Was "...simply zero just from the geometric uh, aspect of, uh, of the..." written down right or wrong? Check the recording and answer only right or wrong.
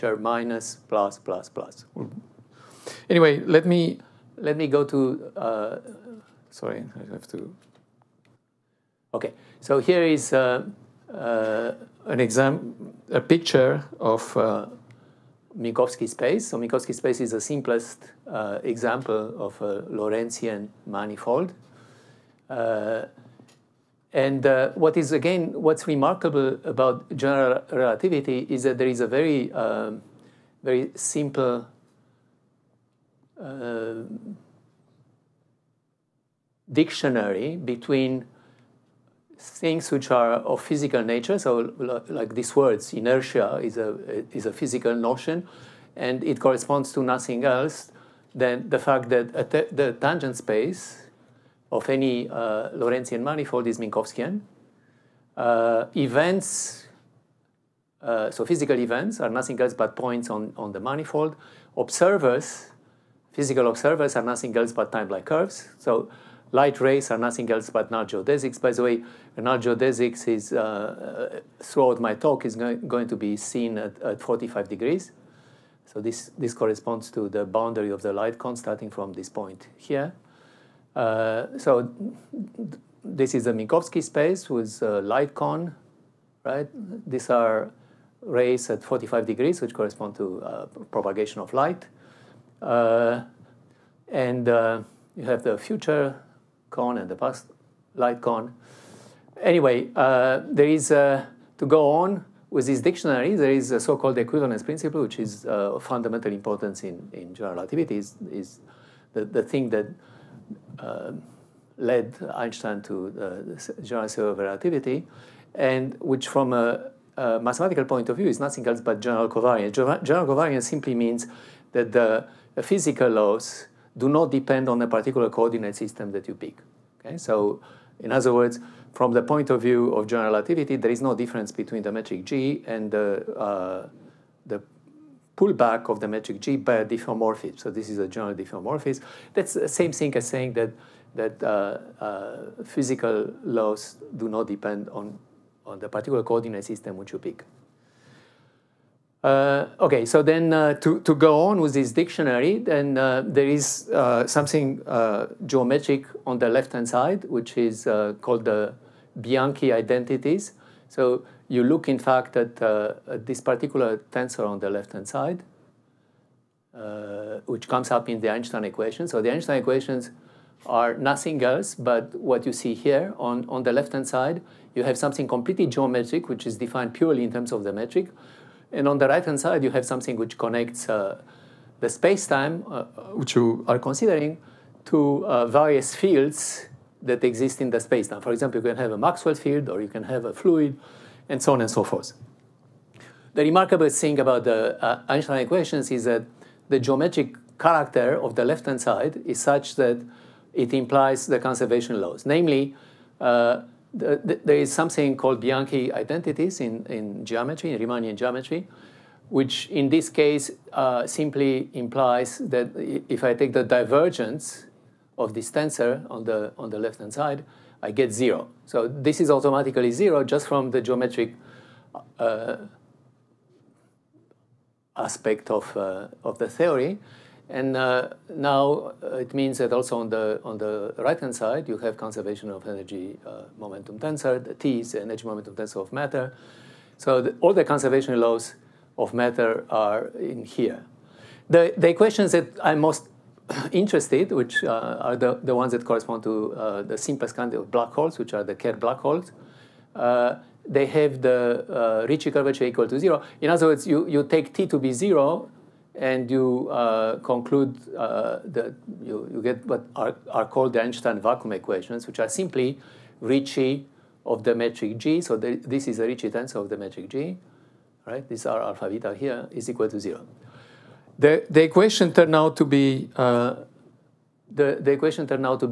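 wrong.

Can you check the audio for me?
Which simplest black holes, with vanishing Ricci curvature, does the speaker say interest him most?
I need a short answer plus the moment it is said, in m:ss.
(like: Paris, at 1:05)
Kerr black holes, at 4:08.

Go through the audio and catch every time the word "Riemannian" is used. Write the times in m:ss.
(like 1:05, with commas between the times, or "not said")
3:27.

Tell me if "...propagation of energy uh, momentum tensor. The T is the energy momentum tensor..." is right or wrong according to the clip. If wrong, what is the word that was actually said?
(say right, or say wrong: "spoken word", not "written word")
wrong: "conservation", not "propagation".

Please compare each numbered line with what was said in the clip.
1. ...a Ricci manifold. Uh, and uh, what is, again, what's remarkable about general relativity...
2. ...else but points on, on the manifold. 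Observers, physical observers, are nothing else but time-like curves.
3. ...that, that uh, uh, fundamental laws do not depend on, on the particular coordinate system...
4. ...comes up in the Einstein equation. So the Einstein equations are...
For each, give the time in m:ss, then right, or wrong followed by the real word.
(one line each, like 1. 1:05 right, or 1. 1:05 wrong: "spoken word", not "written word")
1. 0:19 wrong: "Lorentzian", not "Ricci"
2. 0:59 right
3. 2:20 wrong: "physical", not "fundamental"
4. 2:47 right.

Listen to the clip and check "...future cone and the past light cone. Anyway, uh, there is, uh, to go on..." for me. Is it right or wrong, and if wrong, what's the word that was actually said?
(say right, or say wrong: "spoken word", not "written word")
right.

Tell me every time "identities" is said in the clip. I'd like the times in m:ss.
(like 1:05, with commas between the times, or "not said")
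2:39, 3:25.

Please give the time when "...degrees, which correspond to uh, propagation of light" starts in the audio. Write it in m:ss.
1:29.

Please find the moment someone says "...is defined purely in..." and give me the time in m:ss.
2:56.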